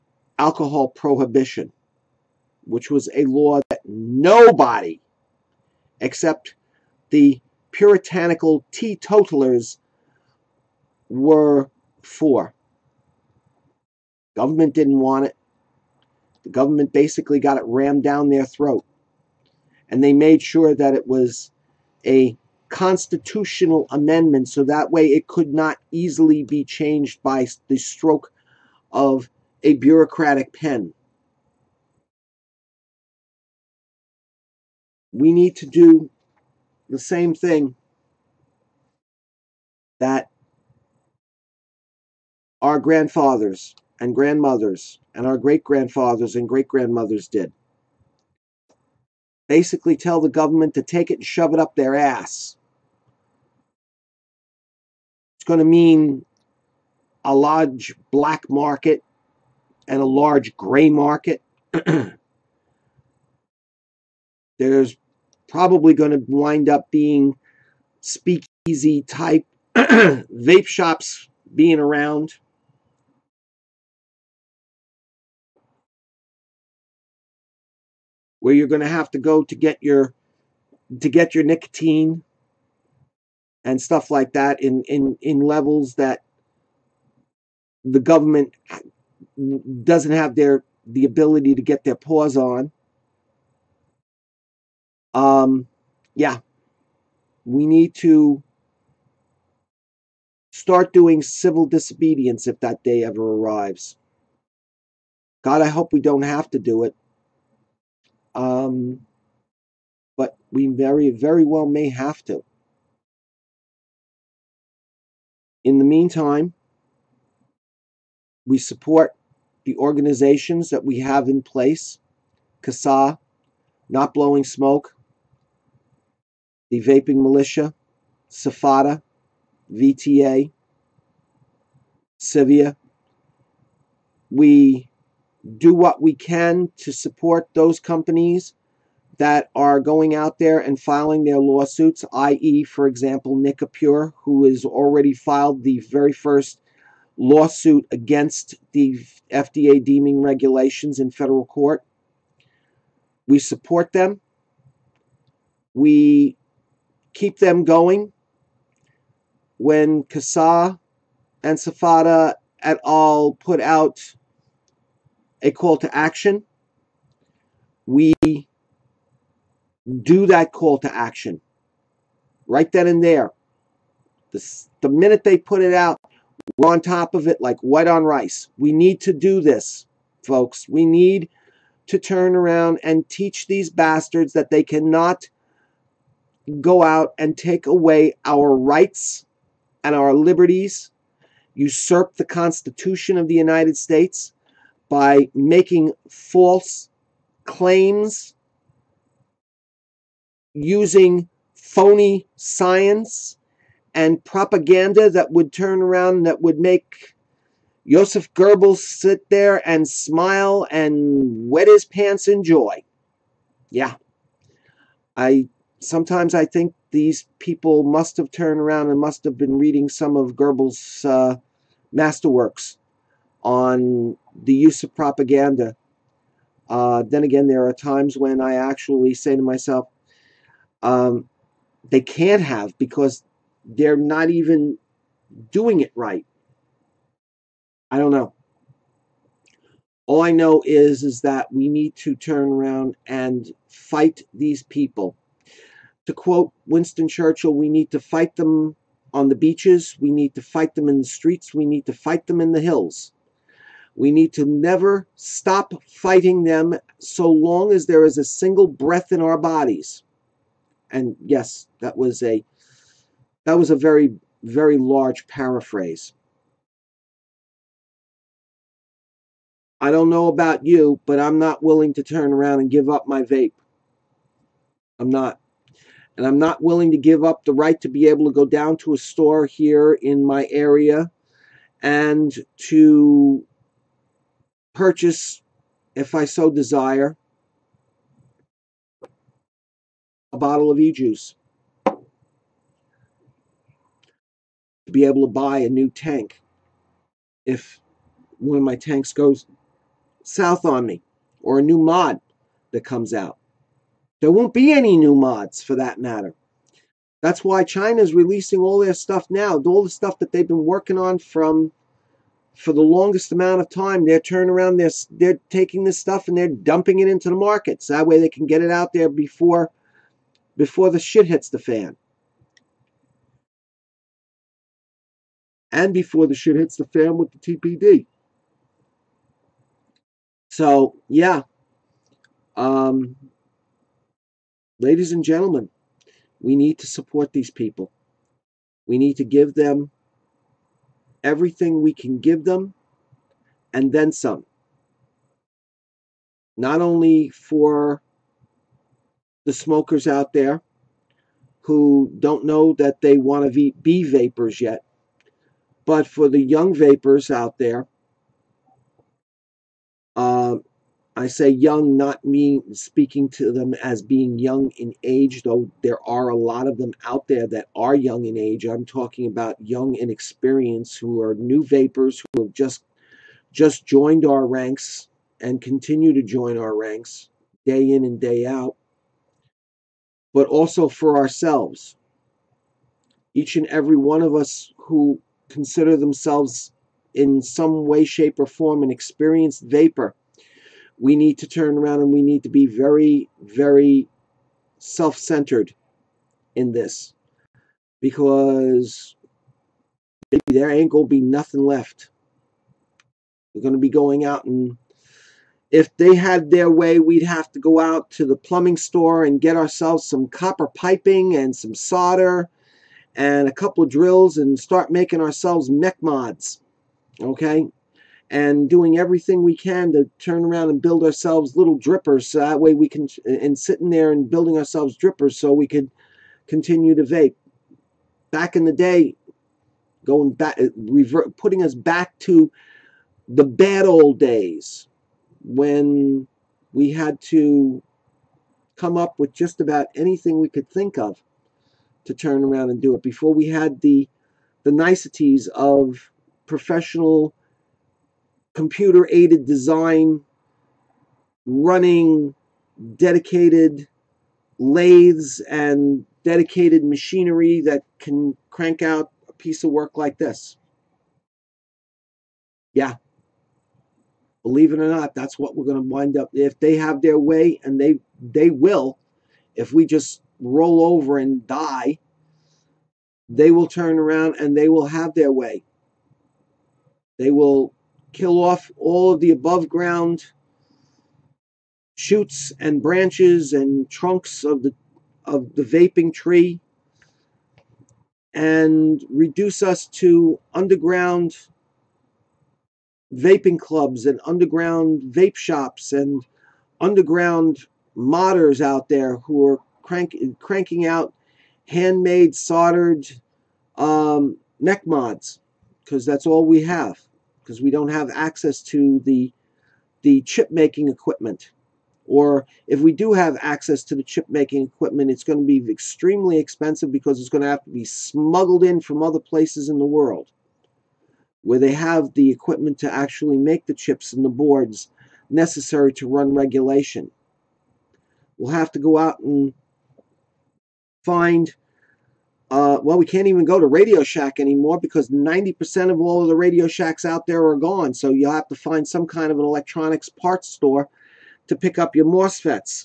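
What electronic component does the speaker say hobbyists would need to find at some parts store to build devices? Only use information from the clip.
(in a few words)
MOSFETs.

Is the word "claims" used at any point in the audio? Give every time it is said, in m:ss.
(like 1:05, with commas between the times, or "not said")
3:17.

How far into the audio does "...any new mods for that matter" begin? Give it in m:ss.
5:04.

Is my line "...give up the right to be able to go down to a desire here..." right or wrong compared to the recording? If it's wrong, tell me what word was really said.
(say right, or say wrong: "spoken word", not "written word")
wrong: "store", not "desire".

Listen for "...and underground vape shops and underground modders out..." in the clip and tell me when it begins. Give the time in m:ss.
8:14.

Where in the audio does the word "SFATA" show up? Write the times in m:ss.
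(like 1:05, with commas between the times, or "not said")
2:08, 2:41.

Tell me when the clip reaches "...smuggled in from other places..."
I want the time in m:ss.
8:37.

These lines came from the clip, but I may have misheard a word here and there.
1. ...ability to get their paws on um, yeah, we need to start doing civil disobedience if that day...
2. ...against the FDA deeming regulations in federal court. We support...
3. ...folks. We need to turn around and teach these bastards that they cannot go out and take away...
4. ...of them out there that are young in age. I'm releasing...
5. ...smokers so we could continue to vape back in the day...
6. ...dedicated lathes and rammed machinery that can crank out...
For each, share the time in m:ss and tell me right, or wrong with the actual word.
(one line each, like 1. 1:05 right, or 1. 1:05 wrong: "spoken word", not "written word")
1. 1:31 right
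2. 2:27 right
3. 3:00 right
4. 6:06 wrong: "talking", not "releasing"
5. 7:04 wrong: "drippers", not "smokers"
6. 7:32 wrong: "dedicated", not "rammed".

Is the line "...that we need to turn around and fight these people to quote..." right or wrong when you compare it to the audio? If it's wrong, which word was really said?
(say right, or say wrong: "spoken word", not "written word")
right.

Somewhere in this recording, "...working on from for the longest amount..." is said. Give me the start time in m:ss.
5:10.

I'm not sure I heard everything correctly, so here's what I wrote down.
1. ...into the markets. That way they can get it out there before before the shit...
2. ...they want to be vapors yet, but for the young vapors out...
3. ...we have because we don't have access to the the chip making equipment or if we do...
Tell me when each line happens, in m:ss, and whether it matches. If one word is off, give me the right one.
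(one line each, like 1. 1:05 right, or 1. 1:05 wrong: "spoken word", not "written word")
1. 5:17 right
2. 5:53 right
3. 8:26 right.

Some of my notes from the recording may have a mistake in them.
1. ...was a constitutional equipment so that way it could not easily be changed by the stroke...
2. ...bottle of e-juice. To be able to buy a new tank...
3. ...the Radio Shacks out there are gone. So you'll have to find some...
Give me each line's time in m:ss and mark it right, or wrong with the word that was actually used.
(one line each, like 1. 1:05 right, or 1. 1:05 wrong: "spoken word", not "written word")
1. 0:21 wrong: "amendment", not "equipment"
2. 4:50 right
3. 8:56 right.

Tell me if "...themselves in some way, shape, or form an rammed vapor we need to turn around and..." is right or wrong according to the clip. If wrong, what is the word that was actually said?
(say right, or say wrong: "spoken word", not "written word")
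wrong: "experienced", not "rammed".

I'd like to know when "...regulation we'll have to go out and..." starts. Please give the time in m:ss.
8:46.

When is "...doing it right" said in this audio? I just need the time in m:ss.
3:55.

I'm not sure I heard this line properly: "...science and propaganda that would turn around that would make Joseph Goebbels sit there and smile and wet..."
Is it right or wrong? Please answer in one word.
right.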